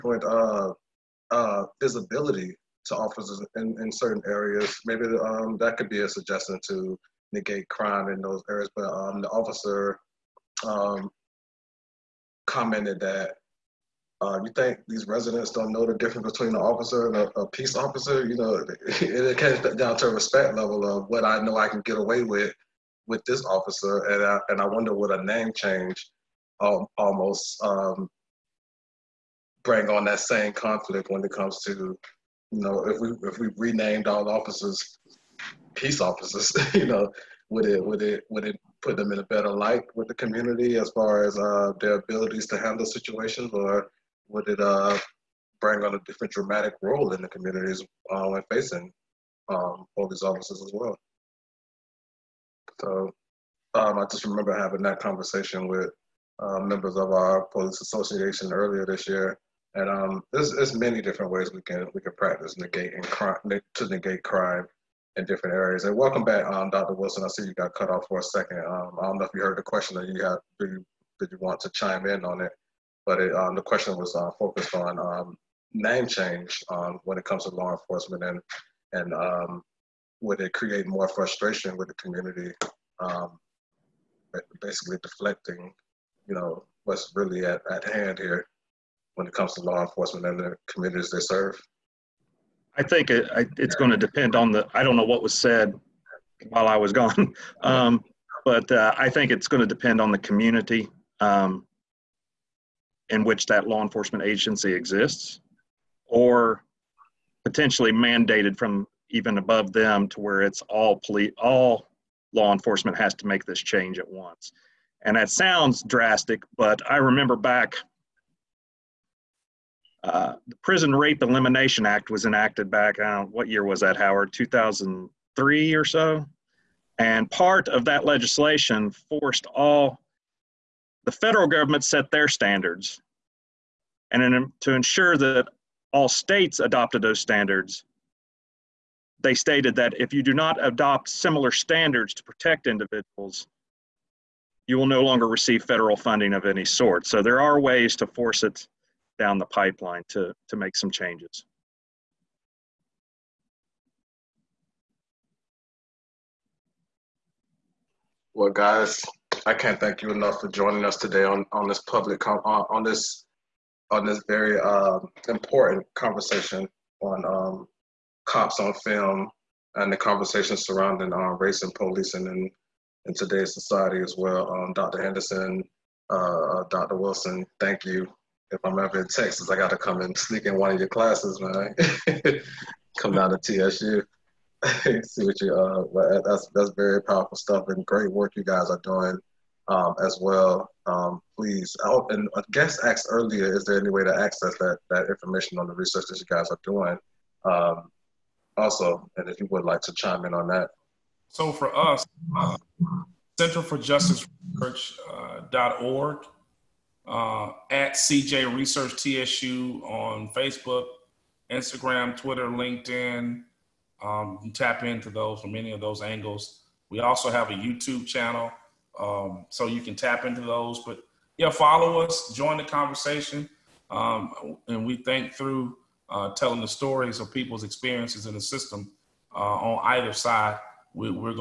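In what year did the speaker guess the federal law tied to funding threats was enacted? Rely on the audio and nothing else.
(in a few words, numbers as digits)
2003.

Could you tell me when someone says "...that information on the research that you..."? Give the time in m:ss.
3:14.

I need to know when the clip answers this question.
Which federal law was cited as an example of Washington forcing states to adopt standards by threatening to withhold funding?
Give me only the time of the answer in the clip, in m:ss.
2:00.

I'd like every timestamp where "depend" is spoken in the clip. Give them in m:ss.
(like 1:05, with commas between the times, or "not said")
1:33, 1:39.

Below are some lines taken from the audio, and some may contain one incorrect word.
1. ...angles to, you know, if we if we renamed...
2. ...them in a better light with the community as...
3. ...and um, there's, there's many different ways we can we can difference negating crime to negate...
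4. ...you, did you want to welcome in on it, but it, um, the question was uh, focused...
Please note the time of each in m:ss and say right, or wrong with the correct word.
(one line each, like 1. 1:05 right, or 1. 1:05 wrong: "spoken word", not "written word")
1. 0:31 wrong: "comes", not "angles"
2. 0:38 right
3. 0:59 wrong: "practice", not "difference"
4. 1:10 wrong: "chime", not "welcome".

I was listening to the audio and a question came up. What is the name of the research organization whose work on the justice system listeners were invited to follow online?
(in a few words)
Center for Justice Research.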